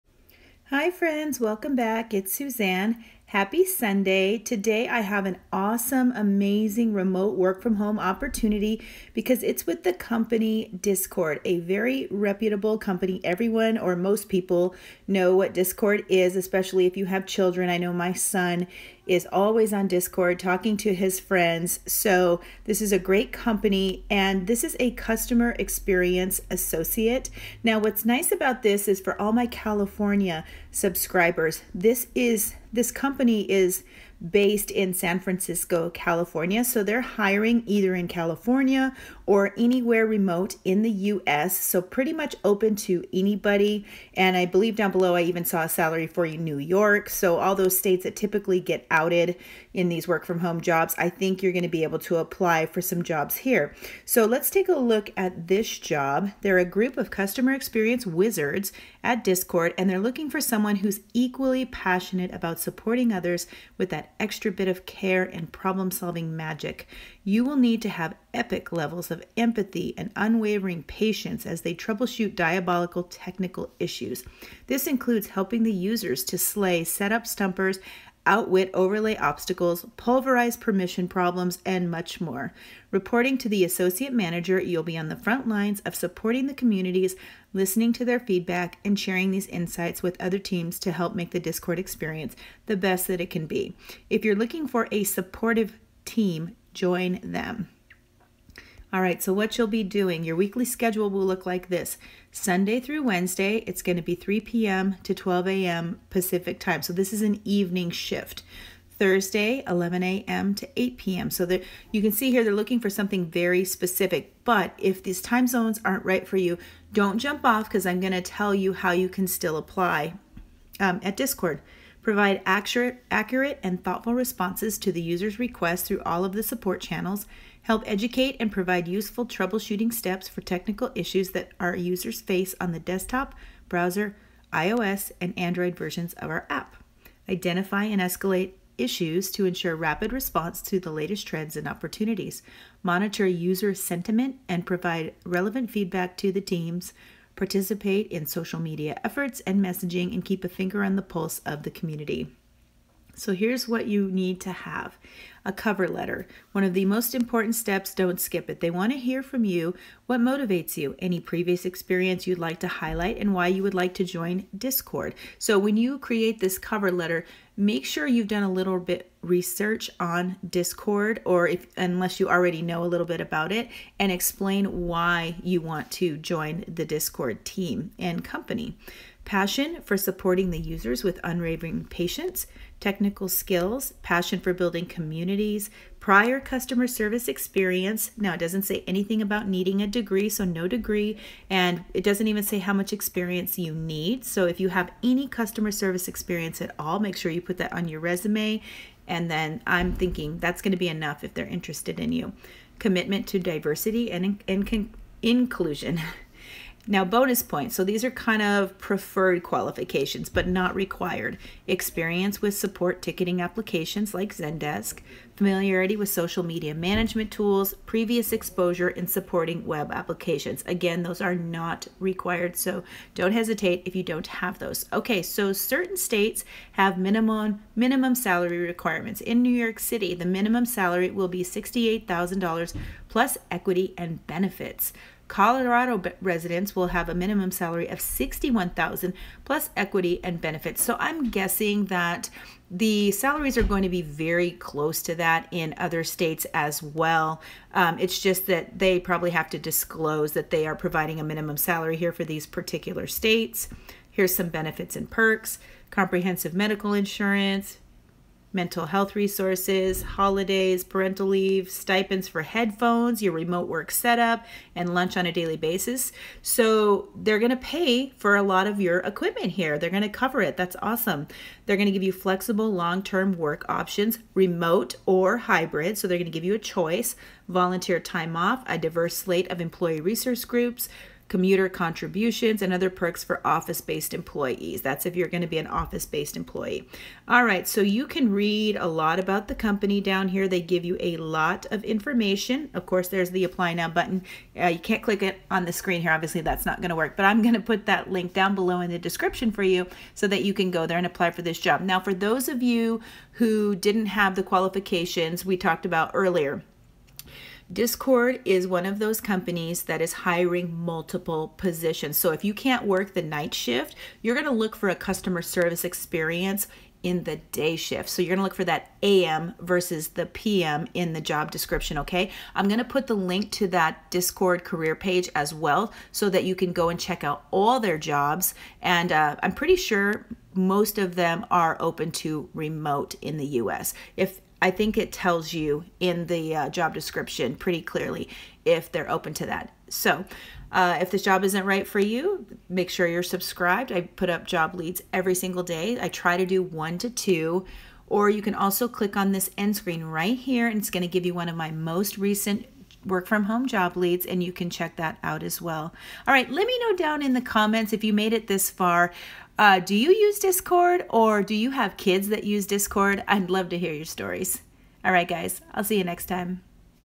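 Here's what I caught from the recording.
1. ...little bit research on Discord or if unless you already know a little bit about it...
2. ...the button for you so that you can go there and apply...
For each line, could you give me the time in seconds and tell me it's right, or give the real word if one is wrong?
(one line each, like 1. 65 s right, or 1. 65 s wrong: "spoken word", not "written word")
1. 168 s right
2. 298 s wrong: "description", not "button".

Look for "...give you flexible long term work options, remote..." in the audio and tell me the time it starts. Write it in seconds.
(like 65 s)
271 s.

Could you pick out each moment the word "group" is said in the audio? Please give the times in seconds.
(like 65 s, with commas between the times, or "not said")
56 s, 280 s.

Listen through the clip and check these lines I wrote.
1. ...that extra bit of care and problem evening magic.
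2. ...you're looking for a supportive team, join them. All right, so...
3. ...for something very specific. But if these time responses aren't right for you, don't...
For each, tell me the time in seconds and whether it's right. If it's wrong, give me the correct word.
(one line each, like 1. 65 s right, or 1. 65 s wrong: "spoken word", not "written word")
1. 63 s wrong: "solving", not "evening"
2. 94 s right
3. 112 s wrong: "zones", not "responses".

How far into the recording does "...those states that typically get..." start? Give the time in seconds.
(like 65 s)
47 s.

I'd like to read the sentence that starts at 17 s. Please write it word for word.
I know my son is always on Discord talking to his friends.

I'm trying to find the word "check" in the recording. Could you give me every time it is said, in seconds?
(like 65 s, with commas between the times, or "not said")
326 s, 354 s.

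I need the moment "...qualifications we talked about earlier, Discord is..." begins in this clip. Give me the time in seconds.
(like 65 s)
304 s.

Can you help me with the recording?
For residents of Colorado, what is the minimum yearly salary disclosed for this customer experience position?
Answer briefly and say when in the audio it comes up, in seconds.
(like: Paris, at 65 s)
61,000, at 238 s.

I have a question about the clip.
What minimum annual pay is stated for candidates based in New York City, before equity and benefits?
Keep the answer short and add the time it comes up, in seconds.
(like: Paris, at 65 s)
$68,000, at 231 s.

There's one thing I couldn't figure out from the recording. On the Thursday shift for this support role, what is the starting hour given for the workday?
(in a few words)
11 a.m.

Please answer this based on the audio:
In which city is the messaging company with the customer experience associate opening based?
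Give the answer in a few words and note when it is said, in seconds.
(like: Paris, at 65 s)
San Francisco, at 34 s.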